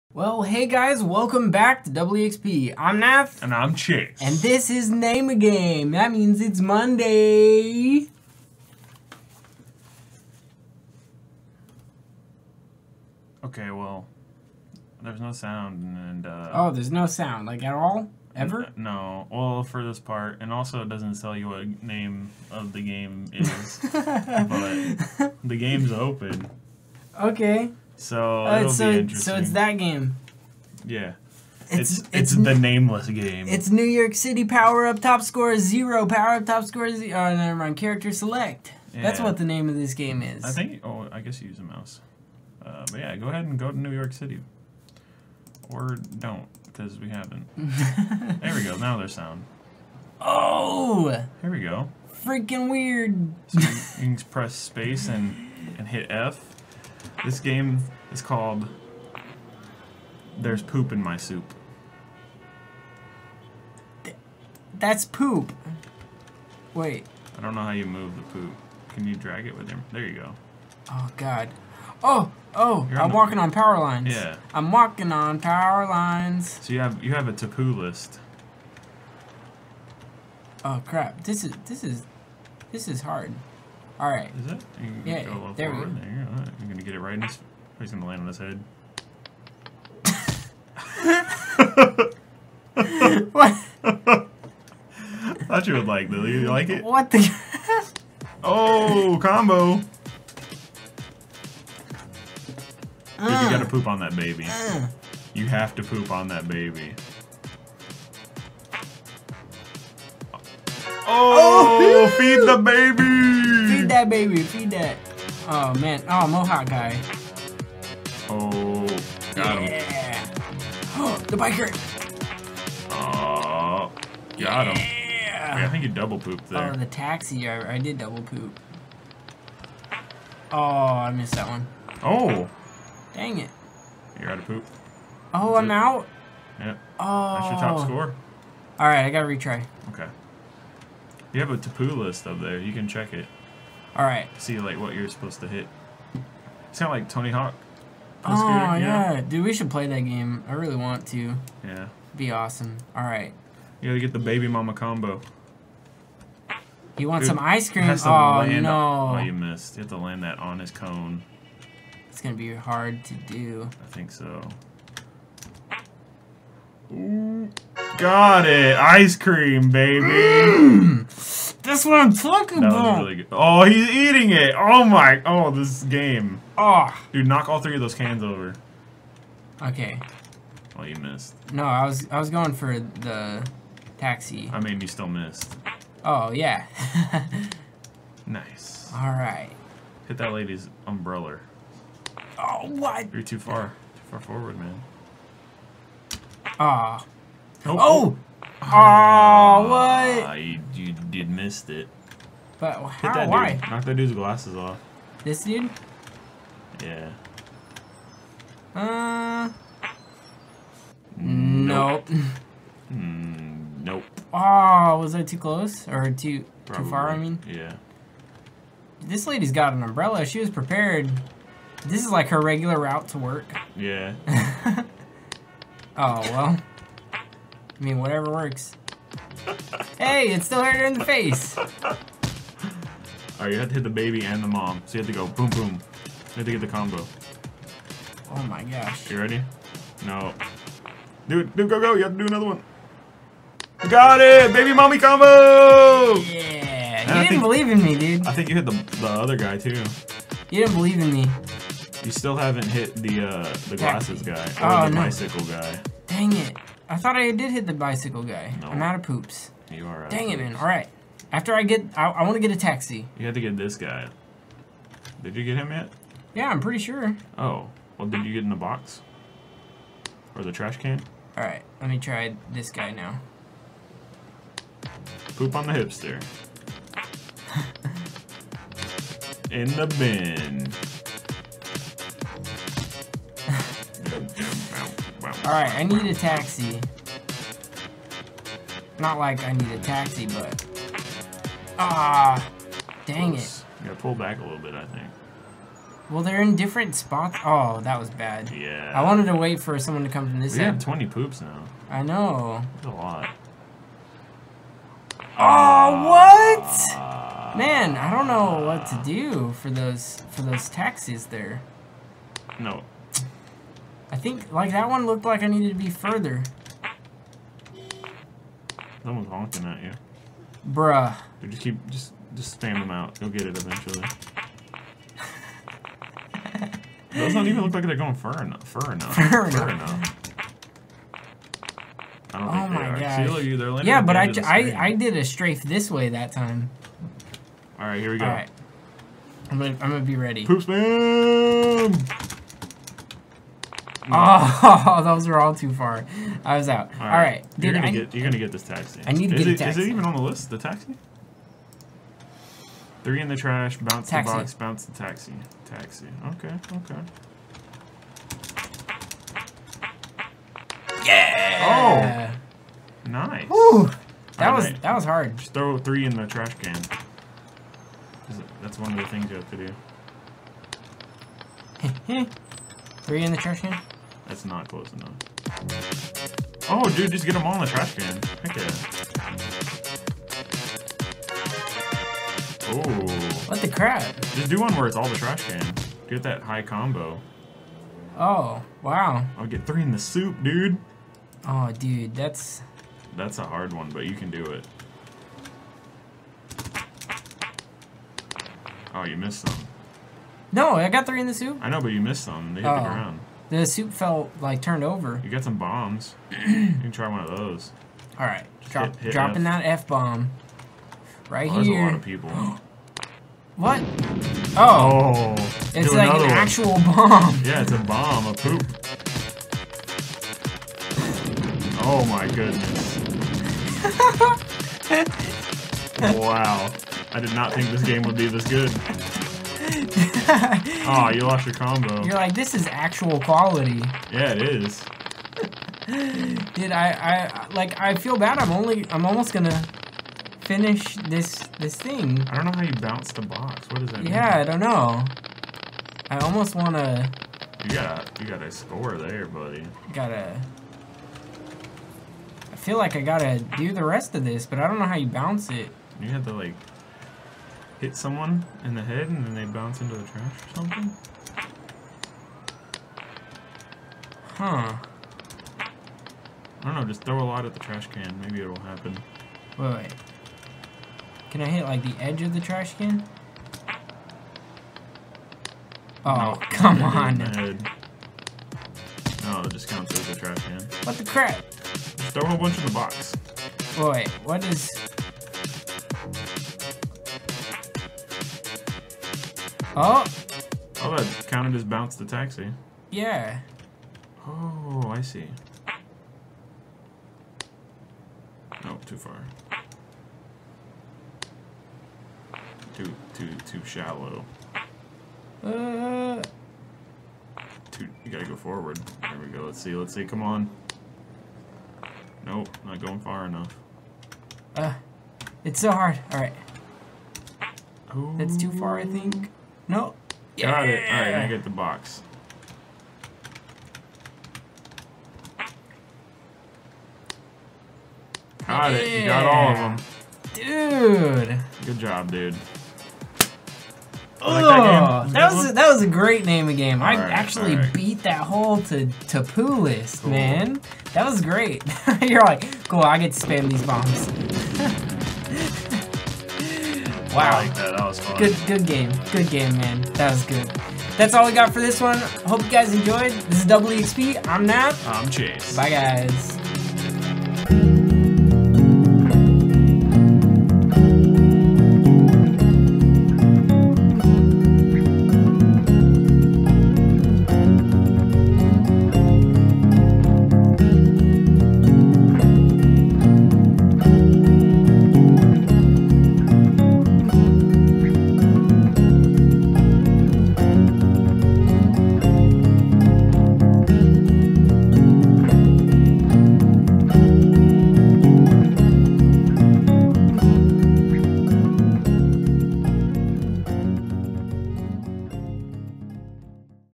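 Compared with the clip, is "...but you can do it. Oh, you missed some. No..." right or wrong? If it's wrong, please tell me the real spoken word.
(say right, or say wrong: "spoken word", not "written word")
right.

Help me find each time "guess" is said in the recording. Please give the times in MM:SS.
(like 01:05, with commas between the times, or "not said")
00:41.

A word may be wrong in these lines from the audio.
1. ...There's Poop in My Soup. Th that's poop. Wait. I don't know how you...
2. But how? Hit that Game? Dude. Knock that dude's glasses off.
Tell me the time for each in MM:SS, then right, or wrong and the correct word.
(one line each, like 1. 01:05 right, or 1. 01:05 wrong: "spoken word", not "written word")
1. 01:00 right
2. 03:22 wrong: "Why", not "Game".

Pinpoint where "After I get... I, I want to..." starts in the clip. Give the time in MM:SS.
04:21.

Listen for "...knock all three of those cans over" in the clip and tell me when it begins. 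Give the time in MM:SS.
02:57.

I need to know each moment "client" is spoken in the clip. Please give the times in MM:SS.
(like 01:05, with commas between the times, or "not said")
not said.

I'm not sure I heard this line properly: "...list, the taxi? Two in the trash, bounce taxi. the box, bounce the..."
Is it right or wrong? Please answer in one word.
wrong.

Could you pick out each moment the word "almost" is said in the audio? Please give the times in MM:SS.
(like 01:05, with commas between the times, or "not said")
07:19, 07:26.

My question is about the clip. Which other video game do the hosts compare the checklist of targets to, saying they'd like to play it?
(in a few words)
Tony Hawk.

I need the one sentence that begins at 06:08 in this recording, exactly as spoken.
That's one of the things you have to do.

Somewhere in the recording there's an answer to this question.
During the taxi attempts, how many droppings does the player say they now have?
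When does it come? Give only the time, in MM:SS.
05:00.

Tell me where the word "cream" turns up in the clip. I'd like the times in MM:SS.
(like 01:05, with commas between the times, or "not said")
02:37, 02:49.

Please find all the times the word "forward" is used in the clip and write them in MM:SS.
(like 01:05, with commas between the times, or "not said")
01:25, 03:14, 08:28.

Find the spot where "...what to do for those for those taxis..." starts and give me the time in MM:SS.
05:08.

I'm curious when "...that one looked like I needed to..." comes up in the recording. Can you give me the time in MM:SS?
05:14.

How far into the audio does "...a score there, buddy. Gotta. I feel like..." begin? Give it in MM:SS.
07:28.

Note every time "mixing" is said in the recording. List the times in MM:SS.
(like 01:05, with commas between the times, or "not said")
not said.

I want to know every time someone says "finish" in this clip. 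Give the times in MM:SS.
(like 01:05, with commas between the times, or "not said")
07:20.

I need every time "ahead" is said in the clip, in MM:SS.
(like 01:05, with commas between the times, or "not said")
00:43.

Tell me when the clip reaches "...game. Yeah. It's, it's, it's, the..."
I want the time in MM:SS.
00:29.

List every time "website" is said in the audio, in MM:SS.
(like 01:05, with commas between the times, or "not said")
not said.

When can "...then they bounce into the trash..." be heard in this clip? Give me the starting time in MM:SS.
07:39.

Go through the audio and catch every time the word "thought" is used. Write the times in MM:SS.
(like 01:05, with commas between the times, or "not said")
01:35, 04:16.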